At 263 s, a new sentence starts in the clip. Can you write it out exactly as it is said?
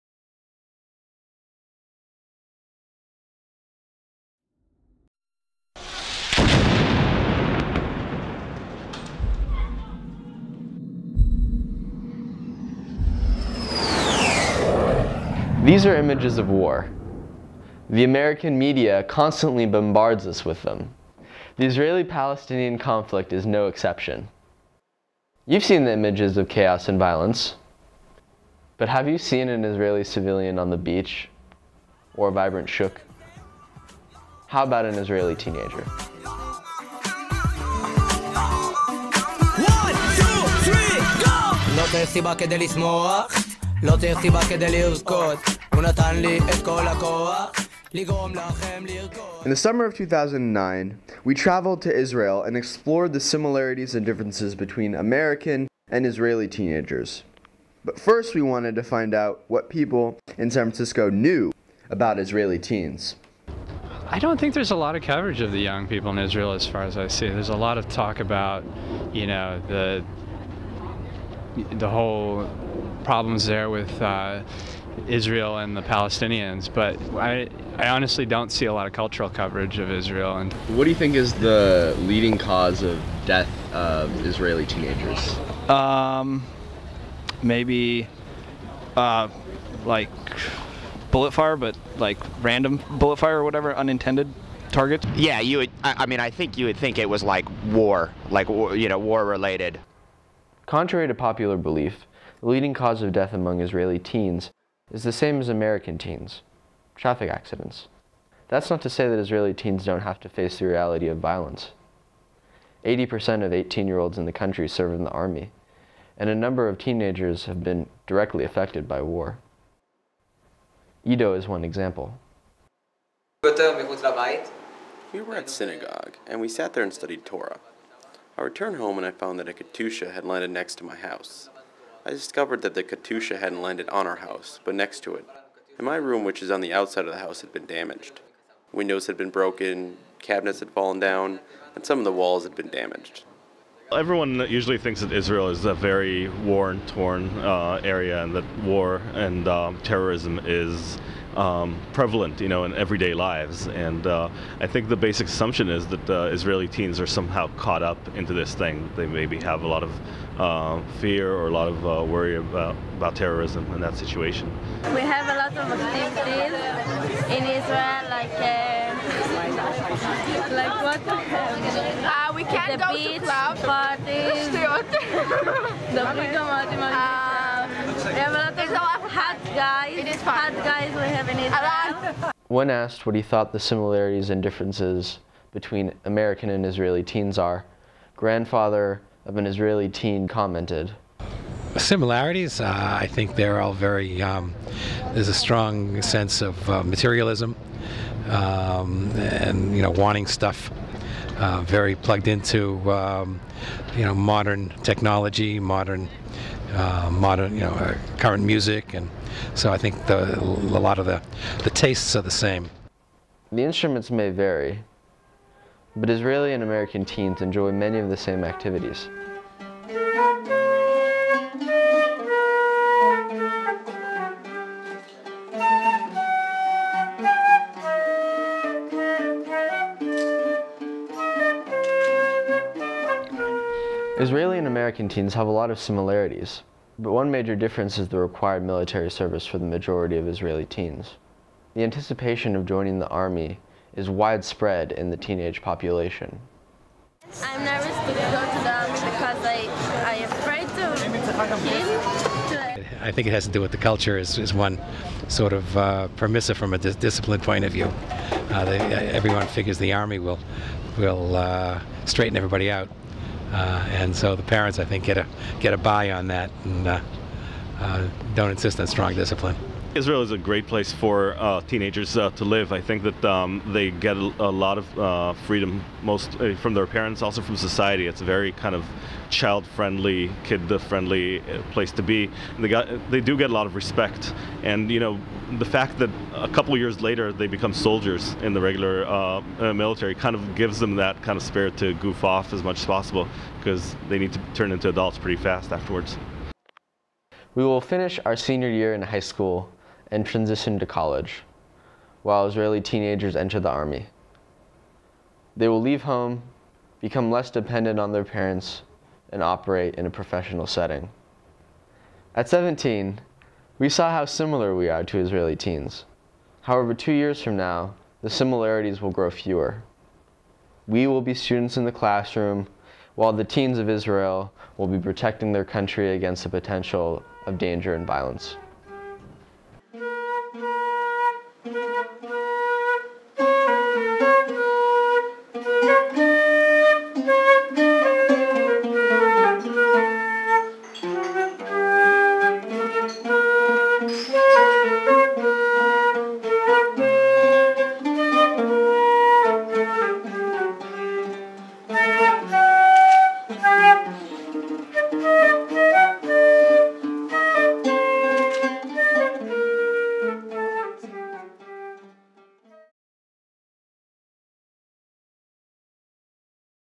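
Uh, and so the parents, I think, get a get a buy on that and uh, uh, don't insist on strong discipline.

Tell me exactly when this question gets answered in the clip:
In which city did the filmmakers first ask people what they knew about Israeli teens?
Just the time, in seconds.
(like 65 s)
60 s.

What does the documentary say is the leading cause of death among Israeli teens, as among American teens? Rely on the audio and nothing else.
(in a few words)
Traffic accidents.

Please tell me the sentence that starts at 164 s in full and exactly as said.
We have a lot of activities in Israel, like uh, like what?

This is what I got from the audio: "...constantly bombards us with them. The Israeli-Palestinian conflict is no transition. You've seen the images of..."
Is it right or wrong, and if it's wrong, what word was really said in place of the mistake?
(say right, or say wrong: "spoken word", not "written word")
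wrong: "exception", not "transition".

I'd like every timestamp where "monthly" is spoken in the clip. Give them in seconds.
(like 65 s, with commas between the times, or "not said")
not said.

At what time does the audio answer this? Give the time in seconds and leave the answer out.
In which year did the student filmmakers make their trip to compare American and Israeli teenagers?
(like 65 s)
49 s.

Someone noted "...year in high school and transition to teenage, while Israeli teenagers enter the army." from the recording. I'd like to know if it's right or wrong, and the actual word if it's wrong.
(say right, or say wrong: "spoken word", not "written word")
wrong: "college", not "teenage".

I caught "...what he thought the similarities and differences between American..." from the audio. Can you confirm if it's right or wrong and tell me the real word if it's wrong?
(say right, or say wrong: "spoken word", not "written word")
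right.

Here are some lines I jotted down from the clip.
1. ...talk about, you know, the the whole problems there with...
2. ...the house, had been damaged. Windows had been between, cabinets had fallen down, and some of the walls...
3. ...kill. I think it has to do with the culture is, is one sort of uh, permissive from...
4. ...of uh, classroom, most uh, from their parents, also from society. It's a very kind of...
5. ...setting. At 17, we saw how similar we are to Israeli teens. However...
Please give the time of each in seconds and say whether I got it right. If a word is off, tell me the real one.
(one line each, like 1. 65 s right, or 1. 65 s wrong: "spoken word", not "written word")
1. 67 s right
2. 137 s wrong: "broken", not "between"
3. 251 s right
4. 274 s wrong: "freedom", not "classroom"
5. 310 s right.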